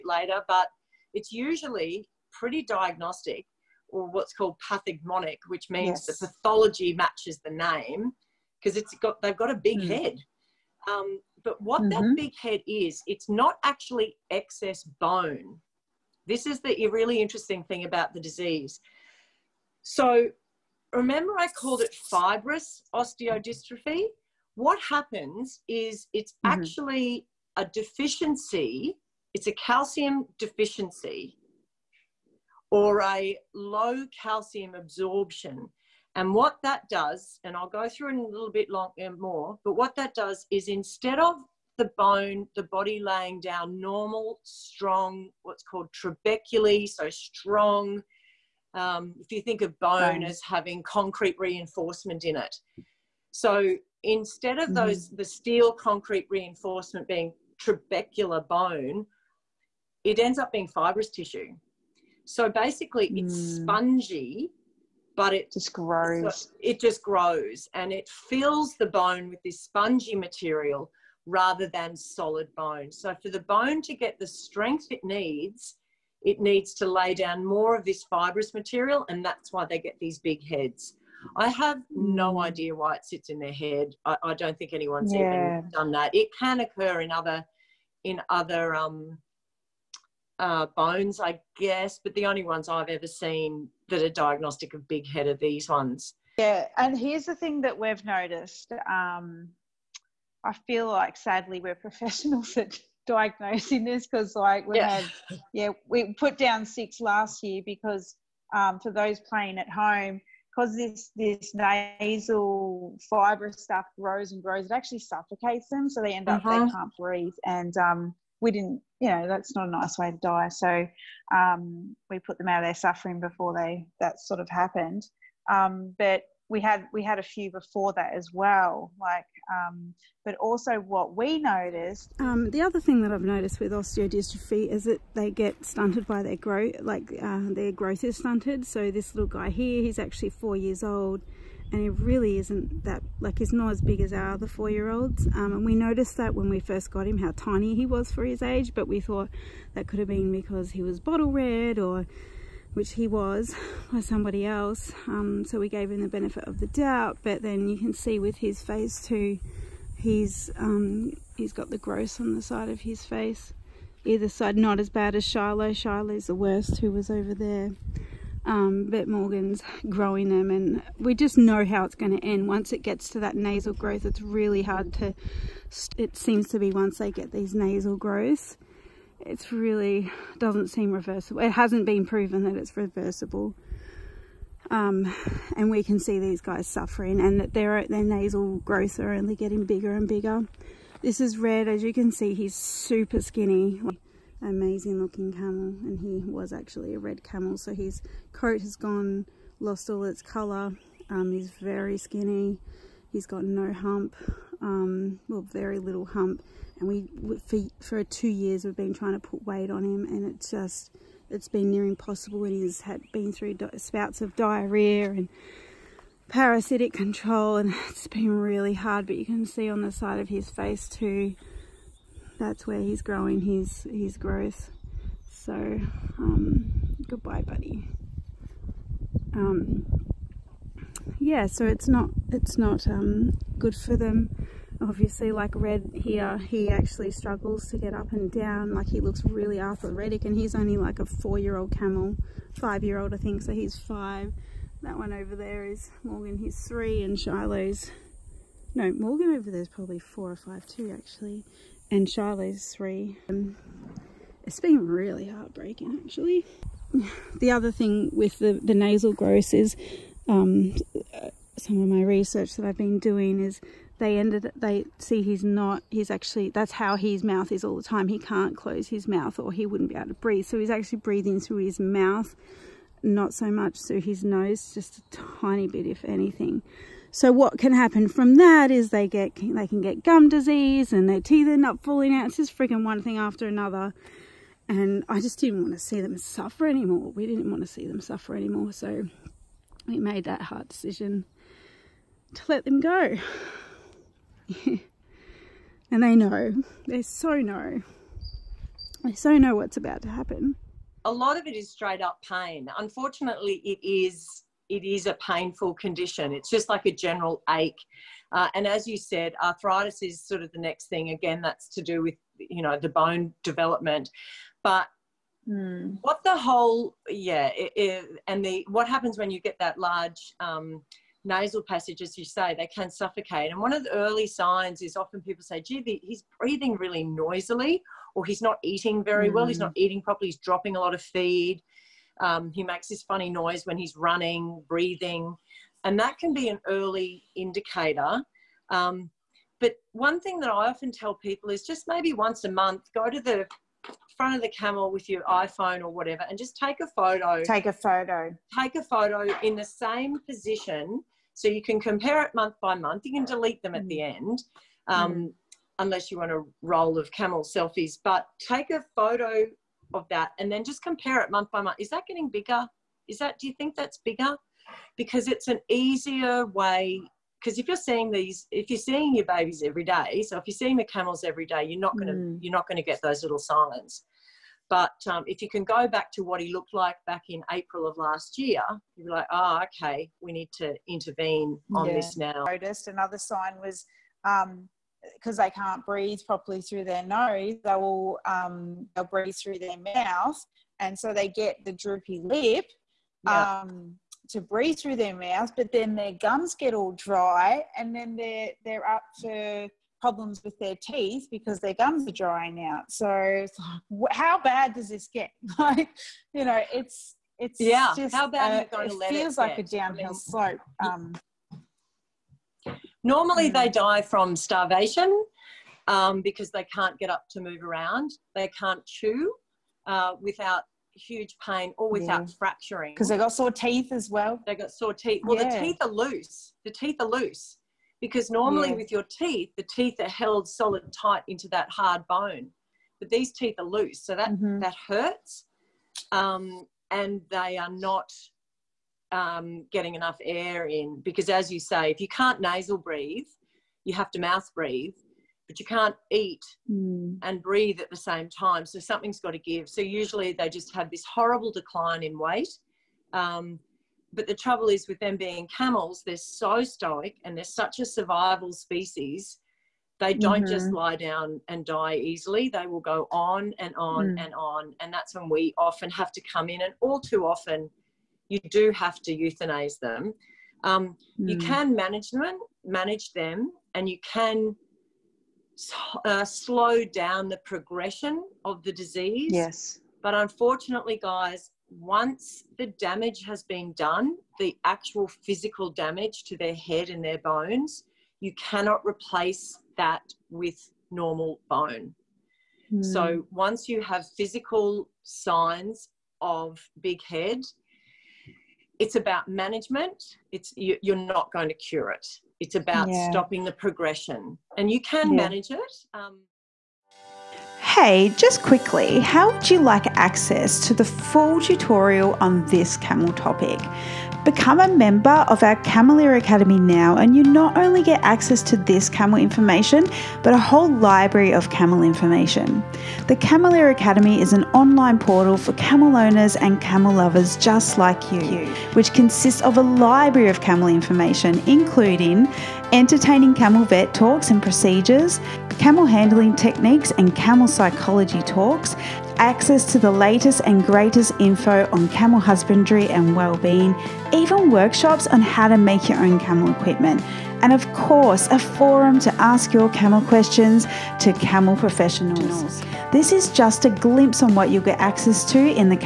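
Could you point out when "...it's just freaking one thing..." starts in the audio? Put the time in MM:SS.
04:42.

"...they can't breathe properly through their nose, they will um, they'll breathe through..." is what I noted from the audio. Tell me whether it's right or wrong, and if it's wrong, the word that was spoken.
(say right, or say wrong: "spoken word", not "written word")
right.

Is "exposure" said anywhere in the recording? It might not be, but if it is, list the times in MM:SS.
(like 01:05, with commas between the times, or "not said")
not said.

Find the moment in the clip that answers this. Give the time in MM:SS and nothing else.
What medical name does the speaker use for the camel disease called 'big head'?
00:22.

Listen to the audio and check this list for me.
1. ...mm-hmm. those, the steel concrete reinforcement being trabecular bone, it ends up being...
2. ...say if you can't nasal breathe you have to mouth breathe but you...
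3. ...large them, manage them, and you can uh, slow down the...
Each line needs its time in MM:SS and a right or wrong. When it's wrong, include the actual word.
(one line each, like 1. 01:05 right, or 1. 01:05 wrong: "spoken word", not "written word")
1. 00:54 right
2. 07:21 right
3. 07:51 wrong: "manage", not "large".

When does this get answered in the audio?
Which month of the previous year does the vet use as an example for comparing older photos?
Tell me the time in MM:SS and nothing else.
06:17.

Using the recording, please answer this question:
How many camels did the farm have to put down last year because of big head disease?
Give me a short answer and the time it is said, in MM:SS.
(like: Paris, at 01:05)
6, at 01:46.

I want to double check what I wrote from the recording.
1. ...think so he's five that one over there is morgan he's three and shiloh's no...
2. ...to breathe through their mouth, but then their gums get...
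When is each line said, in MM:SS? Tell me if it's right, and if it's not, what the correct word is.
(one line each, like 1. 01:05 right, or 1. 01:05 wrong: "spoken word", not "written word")
1. 04:03 right
2. 06:34 right.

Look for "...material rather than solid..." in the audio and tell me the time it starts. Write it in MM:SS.
01:10.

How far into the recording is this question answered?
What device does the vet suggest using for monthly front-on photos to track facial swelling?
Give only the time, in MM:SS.
05:45.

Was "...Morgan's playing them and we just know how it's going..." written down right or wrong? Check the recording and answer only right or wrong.
wrong.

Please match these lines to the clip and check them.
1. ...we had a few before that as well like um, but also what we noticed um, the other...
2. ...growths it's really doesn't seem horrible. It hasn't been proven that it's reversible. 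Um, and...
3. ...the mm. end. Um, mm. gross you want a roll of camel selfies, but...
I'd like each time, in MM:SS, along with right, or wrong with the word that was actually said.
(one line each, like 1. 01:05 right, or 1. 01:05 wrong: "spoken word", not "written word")
1. 02:06 right
2. 02:57 wrong: "reversible", not "horrible"
3. 05:53 wrong: "unless", not "gross".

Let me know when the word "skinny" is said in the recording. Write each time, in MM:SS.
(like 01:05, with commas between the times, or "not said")
03:13, 03:21.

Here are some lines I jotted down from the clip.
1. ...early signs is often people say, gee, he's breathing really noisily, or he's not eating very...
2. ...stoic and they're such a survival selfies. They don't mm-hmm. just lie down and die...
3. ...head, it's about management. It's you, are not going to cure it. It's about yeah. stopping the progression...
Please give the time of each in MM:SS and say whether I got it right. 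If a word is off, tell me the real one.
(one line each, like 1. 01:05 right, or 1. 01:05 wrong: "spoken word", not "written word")
1. 05:23 right
2. 07:36 wrong: "species", not "selfies"
3. 08:17 right.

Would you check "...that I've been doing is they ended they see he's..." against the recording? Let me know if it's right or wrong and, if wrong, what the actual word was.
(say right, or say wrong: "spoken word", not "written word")
right.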